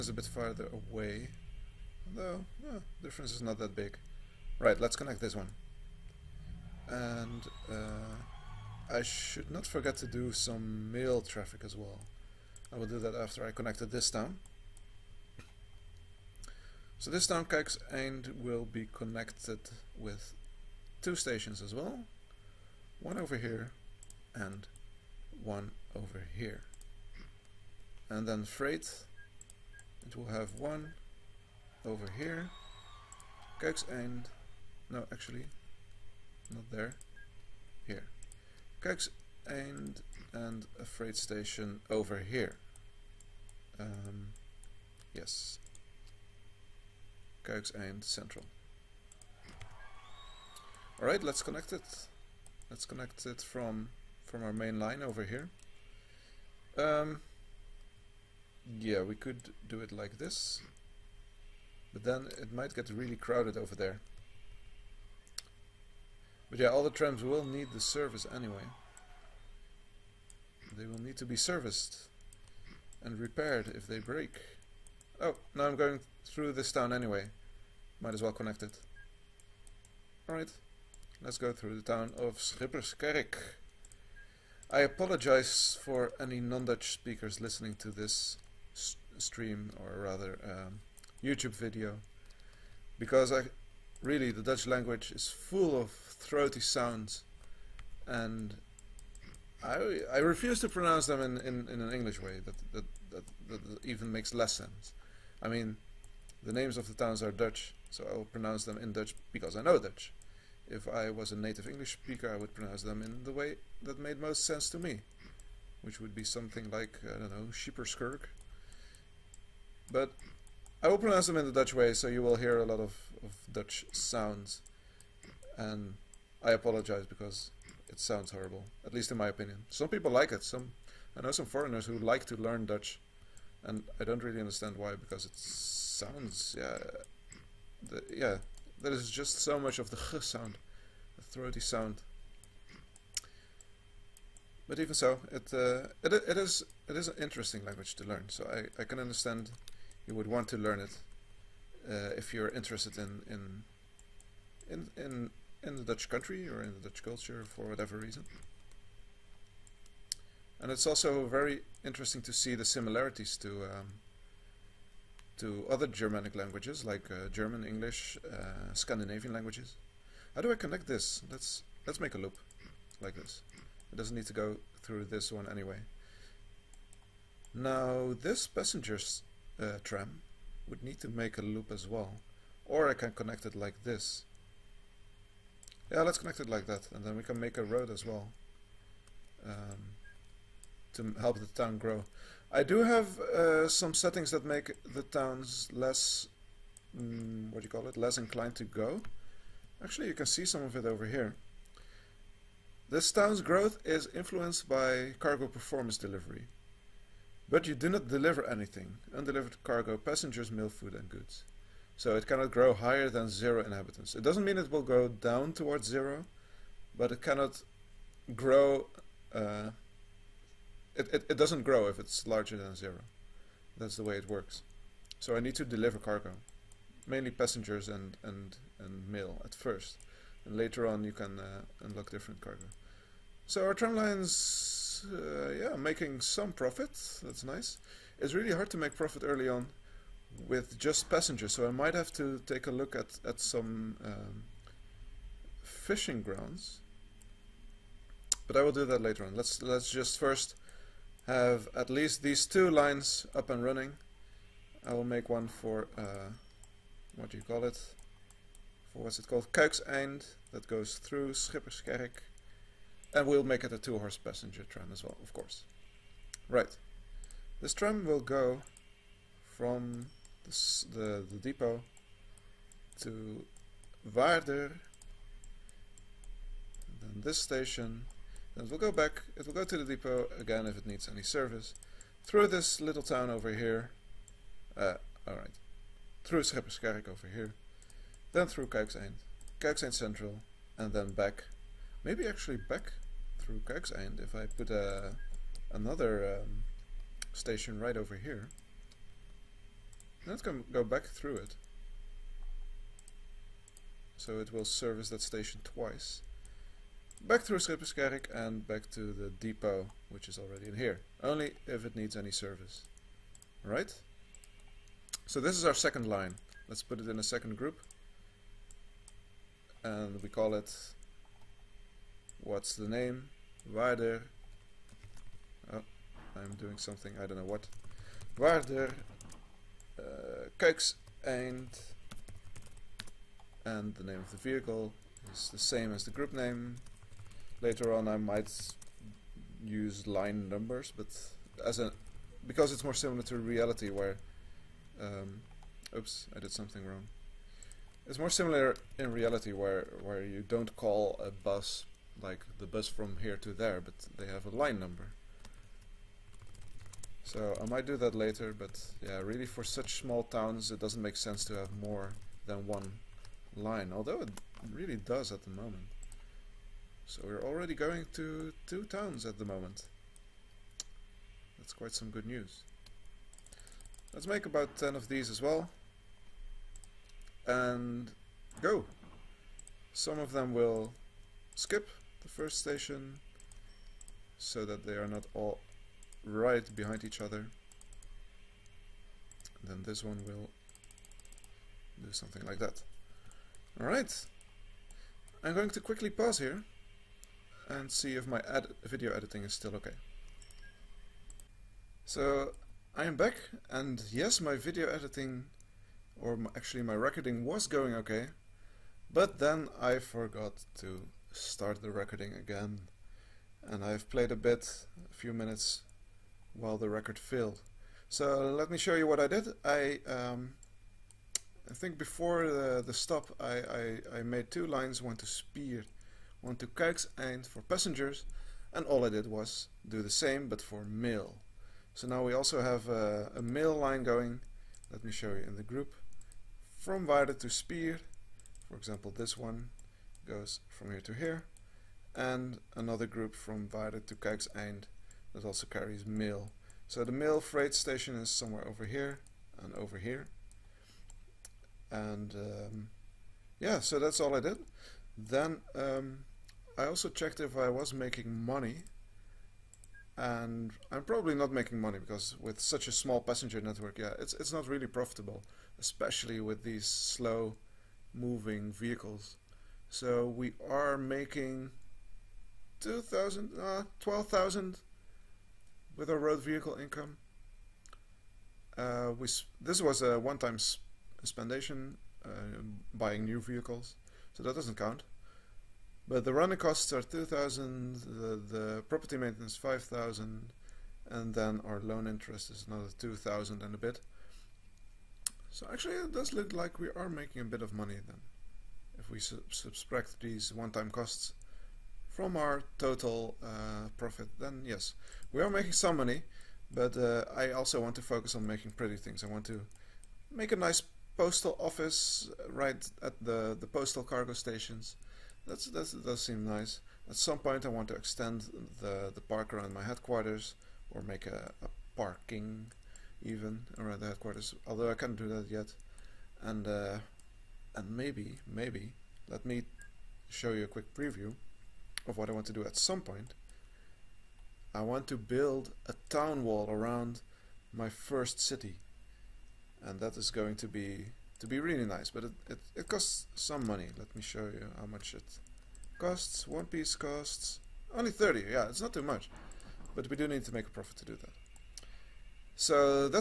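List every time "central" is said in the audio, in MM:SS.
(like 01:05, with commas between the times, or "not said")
00:48, 04:49.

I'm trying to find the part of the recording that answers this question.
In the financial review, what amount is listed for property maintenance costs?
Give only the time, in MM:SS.
08:09.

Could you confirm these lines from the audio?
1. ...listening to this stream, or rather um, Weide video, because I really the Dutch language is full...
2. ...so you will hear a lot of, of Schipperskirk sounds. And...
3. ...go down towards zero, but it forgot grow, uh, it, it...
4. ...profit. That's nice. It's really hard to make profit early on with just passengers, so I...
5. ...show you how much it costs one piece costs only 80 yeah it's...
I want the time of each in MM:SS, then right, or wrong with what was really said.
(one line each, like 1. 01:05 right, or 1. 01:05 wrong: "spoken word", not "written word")
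1. 01:27 wrong: "YouTube", not "Weide"
2. 02:01 wrong: "Dutch", not "Schipperskirk"
3. 03:34 wrong: "cannot", not "forgot"
4. 03:56 right
5. 09:04 wrong: "30", not "80".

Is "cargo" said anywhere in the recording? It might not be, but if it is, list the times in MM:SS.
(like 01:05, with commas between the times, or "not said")
03:25, 03:29, 03:45, 03:52, 08:34.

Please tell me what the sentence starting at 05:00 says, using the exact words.
Let's go, go back through it.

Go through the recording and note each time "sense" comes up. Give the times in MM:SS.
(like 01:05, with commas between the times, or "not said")
01:44, 01:54, 06:01.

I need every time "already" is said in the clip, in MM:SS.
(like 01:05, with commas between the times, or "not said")
05:10, 06:07.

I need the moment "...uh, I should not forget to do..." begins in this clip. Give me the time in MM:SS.
00:07.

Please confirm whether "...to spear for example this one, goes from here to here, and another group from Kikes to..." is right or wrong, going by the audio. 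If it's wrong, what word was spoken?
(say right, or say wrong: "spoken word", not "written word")
wrong: "Weide", not "Kikes".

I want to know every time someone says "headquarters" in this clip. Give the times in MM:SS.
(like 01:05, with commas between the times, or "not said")
08:39, 08:44.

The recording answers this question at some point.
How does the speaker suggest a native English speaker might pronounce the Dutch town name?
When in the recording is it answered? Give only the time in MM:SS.
01:57.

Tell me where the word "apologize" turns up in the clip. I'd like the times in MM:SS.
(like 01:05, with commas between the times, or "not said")
01:24, 02:06.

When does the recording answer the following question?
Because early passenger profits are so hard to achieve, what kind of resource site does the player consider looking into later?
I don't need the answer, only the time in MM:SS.
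04:05.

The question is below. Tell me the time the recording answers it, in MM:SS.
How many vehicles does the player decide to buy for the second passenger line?
06:14.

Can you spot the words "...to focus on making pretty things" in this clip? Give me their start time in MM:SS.
08:27.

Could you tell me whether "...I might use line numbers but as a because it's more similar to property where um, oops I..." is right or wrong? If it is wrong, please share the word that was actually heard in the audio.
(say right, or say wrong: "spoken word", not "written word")
wrong: "reality", not "property".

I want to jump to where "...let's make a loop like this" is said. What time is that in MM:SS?
02:51.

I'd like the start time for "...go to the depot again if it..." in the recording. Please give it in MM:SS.
04:39.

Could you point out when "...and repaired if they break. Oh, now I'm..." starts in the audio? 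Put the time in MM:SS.
01:13.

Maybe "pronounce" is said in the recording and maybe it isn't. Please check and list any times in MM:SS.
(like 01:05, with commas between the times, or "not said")
01:40, 01:48, 01:52, 02:00.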